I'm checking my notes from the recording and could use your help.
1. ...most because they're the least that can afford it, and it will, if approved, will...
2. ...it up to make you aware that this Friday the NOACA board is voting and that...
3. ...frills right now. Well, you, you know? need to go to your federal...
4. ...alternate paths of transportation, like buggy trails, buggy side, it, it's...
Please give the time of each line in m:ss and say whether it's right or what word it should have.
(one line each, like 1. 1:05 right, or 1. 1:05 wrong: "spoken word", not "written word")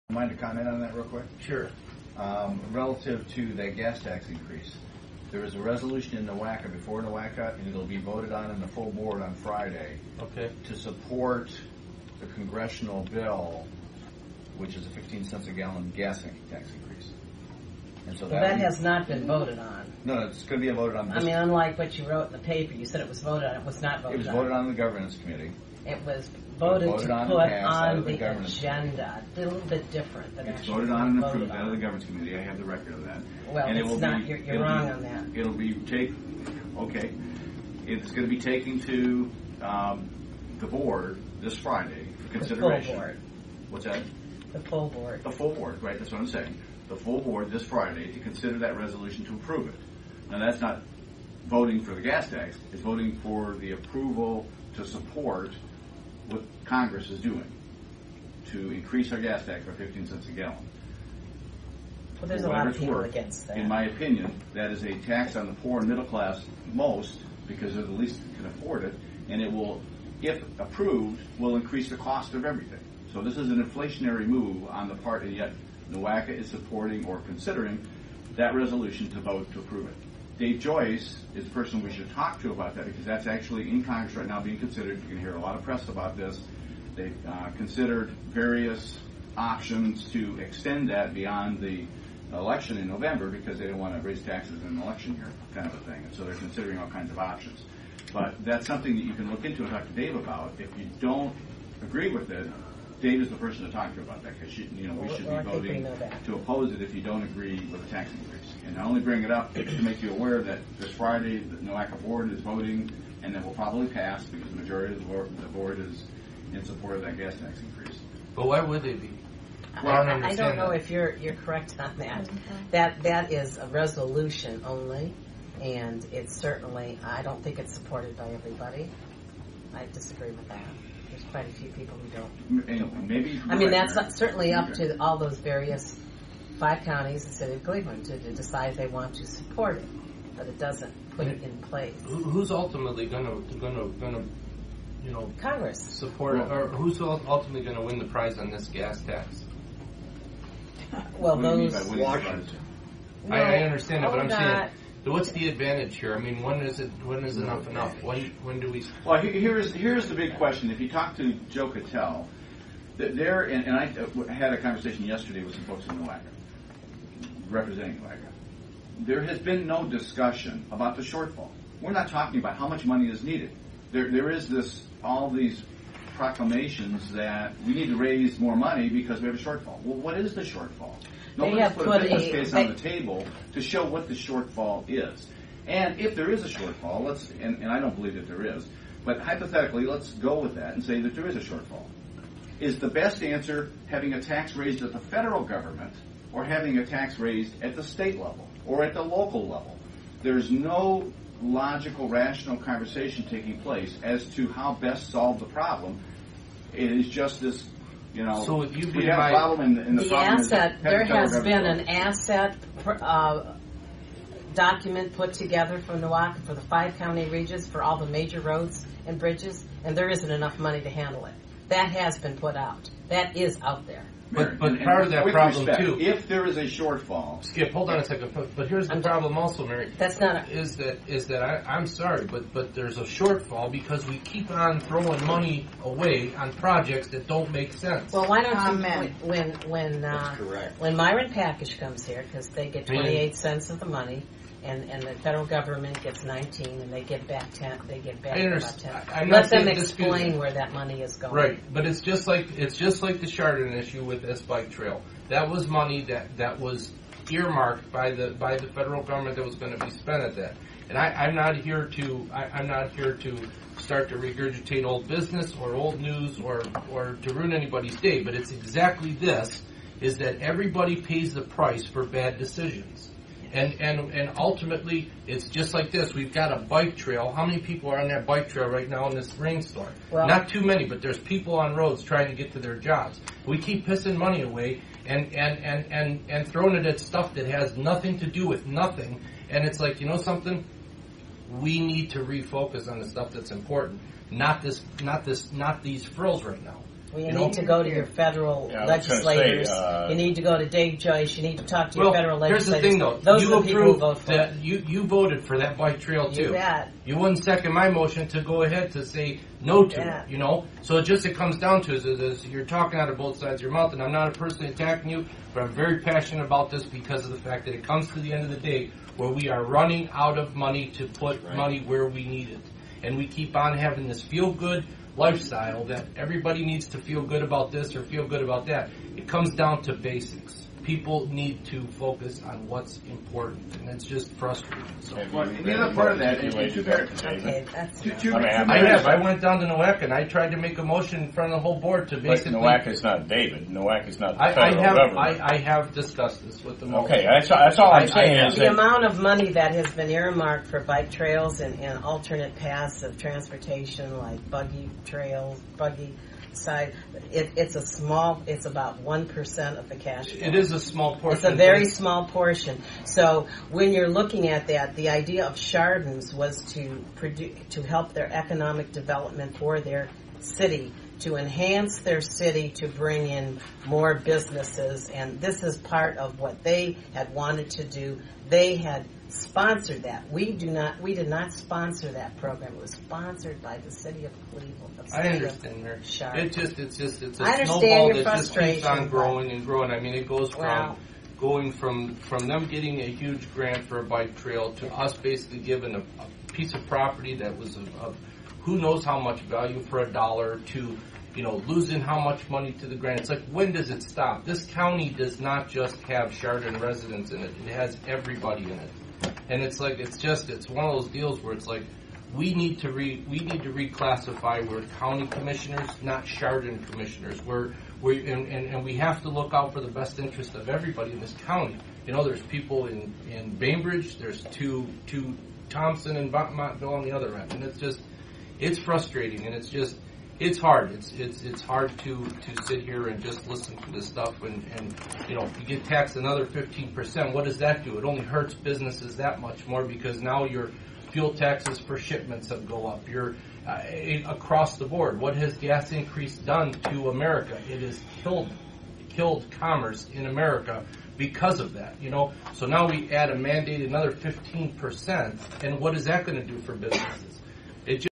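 1. 1:06 right
2. 1:49 right
3. 4:56 right
4. 5:52 right.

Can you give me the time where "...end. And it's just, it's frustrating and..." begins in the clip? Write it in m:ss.
7:07.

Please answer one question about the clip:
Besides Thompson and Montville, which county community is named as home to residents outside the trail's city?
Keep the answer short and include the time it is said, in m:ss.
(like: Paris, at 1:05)
Bainbridge, at 7:03.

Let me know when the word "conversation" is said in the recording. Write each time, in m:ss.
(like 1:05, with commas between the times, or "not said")
2:44, 3:22.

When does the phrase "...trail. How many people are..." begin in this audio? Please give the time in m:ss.
4:36.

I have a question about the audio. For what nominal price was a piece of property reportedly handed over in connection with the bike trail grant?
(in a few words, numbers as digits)
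a dollar.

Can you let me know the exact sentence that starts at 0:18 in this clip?
And so Well, that has not been voted on.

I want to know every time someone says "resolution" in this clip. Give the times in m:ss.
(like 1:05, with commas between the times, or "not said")
0:05, 0:48, 1:18, 2:03.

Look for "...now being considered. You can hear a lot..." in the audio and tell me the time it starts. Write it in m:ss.
1:24.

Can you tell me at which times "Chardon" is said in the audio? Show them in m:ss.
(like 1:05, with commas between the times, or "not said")
4:13, 6:05, 6:46, 6:56.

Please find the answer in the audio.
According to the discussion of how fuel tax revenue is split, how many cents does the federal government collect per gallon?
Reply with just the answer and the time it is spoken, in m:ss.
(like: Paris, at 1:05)
19, at 4:06.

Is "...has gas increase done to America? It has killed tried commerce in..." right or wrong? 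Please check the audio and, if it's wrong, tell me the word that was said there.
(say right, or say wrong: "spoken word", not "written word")
wrong: "killed", not "tried".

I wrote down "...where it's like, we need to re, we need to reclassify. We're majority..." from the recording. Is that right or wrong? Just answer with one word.
wrong.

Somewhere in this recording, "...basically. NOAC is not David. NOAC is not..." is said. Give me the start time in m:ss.
5:42.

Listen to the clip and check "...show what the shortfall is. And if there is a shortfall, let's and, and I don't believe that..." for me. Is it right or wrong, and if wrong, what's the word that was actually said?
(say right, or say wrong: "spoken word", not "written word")
right.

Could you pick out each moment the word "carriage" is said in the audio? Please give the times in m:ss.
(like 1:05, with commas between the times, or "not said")
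not said.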